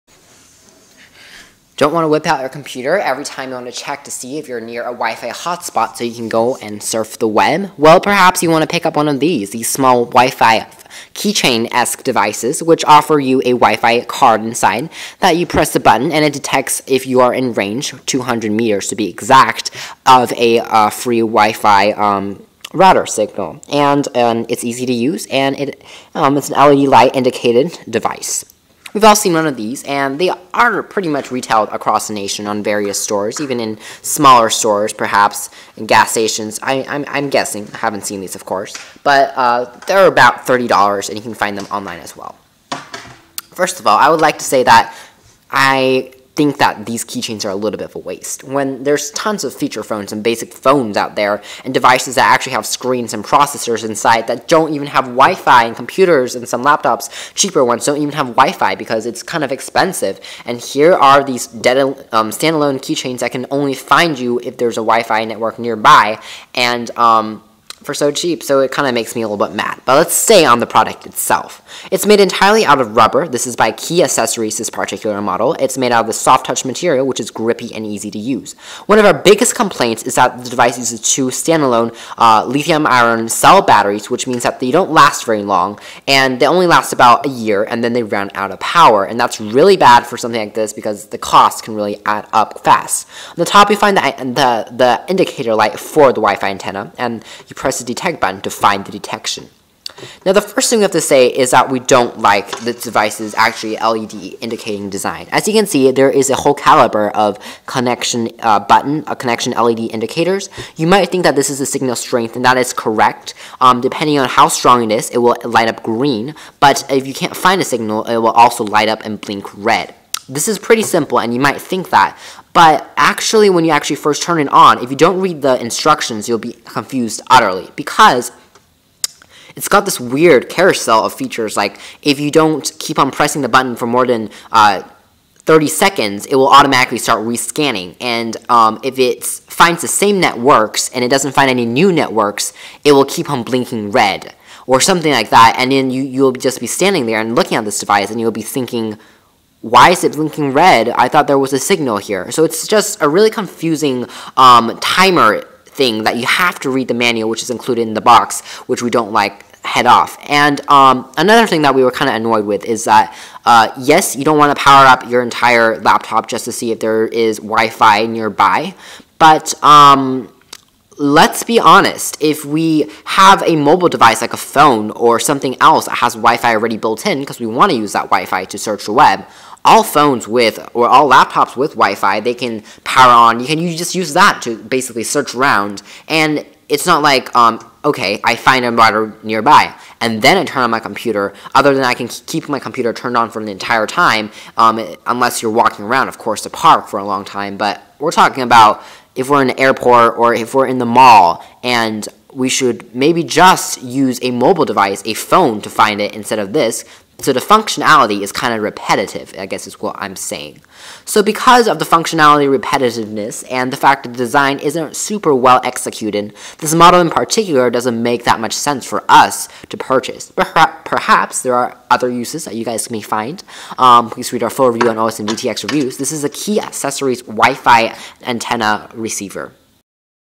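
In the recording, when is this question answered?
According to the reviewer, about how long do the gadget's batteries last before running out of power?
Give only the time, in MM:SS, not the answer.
01:27.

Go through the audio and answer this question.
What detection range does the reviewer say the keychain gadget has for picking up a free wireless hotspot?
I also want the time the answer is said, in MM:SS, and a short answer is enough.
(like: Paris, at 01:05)
200 meters, at 00:18.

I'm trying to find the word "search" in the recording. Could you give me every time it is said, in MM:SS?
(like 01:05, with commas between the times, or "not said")
02:58, 03:05.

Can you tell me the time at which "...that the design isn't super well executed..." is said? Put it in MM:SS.
03:34.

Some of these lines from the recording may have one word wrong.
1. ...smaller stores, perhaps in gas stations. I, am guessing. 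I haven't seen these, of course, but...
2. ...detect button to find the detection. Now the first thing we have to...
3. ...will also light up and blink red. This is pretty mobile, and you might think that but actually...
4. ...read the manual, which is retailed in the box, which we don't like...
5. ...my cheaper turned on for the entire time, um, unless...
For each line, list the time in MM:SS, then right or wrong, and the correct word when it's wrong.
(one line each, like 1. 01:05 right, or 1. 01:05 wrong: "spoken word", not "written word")
1. 00:34 right
2. 01:37 right
3. 01:58 wrong: "simple", not "mobile"
4. 02:36 wrong: "included", not "retailed"
5. 03:12 wrong: "computer", not "cheaper".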